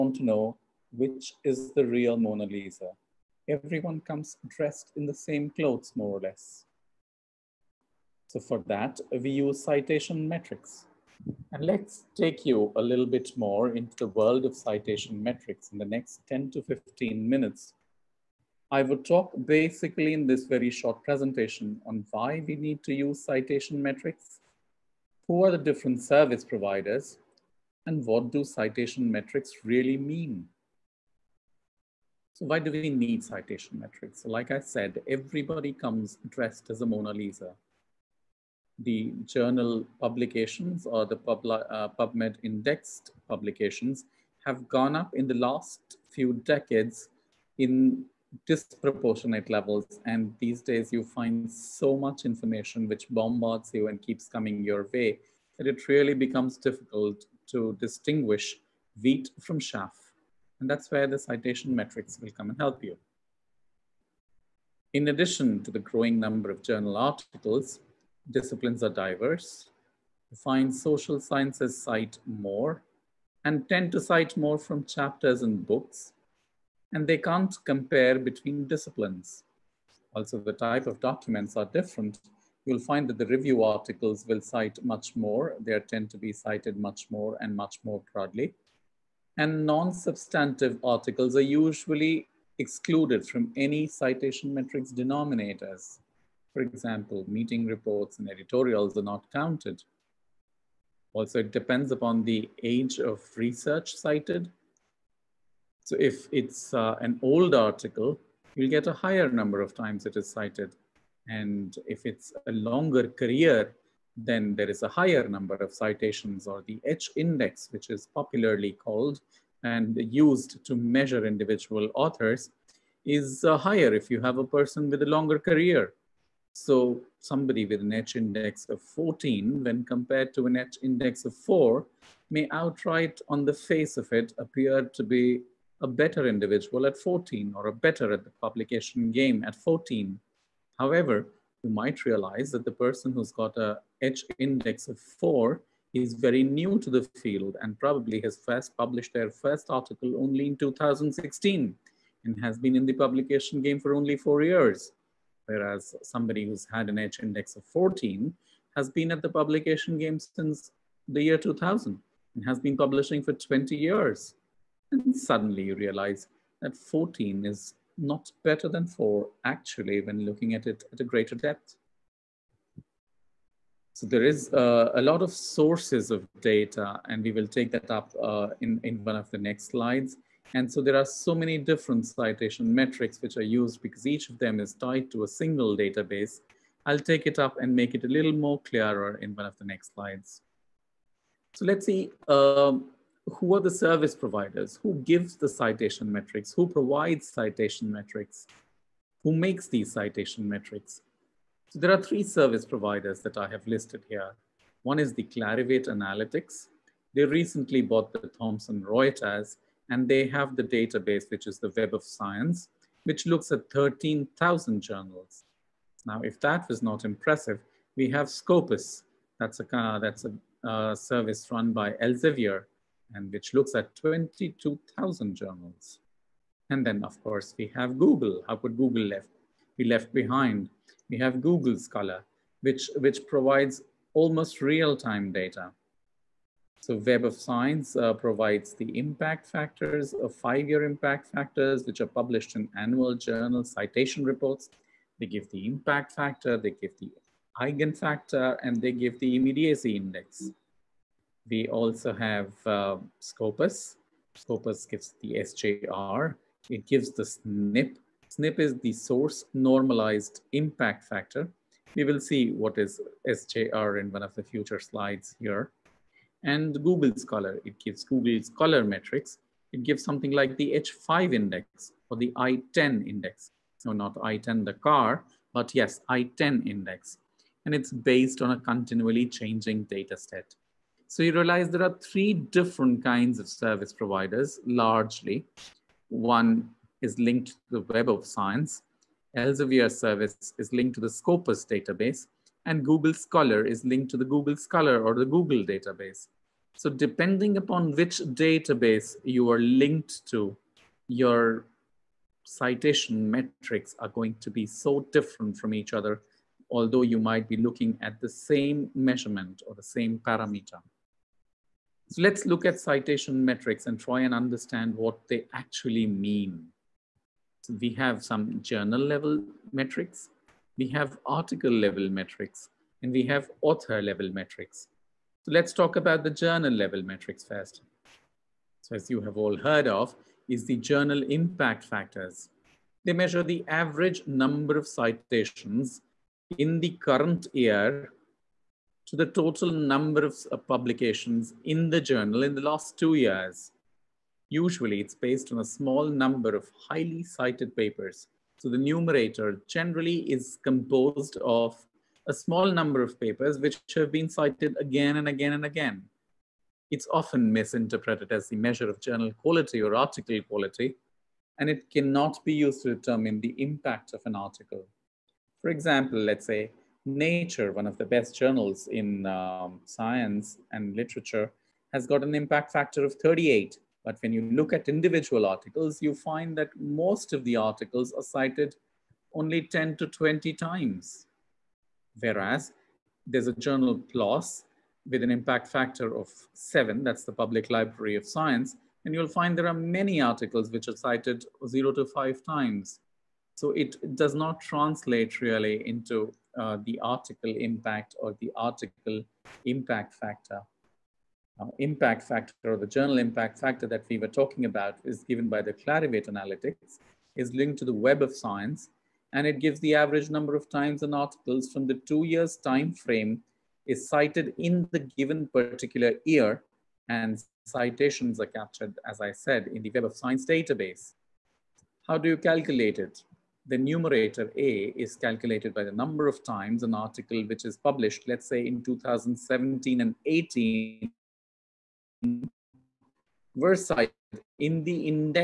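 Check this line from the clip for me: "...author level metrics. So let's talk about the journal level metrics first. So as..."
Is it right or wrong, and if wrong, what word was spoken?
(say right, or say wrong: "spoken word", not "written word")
right.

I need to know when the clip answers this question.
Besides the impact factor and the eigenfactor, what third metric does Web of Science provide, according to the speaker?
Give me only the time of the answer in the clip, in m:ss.
4:09.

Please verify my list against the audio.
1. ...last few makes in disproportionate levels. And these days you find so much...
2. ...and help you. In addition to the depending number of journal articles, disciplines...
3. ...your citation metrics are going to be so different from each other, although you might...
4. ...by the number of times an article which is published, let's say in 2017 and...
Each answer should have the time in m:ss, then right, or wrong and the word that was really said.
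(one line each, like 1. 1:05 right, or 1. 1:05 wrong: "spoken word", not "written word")
1. 0:45 wrong: "decades", not "makes"
2. 1:02 wrong: "growing", not "depending"
3. 5:01 right
4. 7:05 right.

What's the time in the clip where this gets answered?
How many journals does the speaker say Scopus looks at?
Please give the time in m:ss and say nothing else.
3:43.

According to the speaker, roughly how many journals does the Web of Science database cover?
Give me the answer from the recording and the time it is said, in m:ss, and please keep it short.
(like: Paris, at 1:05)
13,000, at 3:33.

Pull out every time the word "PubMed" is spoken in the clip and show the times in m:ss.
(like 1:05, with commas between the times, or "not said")
0:41.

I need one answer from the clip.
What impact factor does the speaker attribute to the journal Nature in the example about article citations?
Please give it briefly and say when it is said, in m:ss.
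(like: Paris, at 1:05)
38, at 6:13.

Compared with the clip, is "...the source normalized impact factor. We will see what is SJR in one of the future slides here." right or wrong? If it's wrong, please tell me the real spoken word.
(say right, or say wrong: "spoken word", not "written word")
right.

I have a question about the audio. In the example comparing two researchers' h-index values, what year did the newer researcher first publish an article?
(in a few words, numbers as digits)
2016.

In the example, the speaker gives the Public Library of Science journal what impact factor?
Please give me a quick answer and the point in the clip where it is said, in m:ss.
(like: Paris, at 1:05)
7, at 6:26.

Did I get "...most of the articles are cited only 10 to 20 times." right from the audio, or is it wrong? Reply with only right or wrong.
right.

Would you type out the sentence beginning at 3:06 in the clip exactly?
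I'll take it up and make it a little more clearer in one of the next slides.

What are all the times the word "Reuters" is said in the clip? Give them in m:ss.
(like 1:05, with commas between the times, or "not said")
3:28.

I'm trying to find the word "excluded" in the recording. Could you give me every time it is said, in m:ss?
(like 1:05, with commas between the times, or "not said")
1:32.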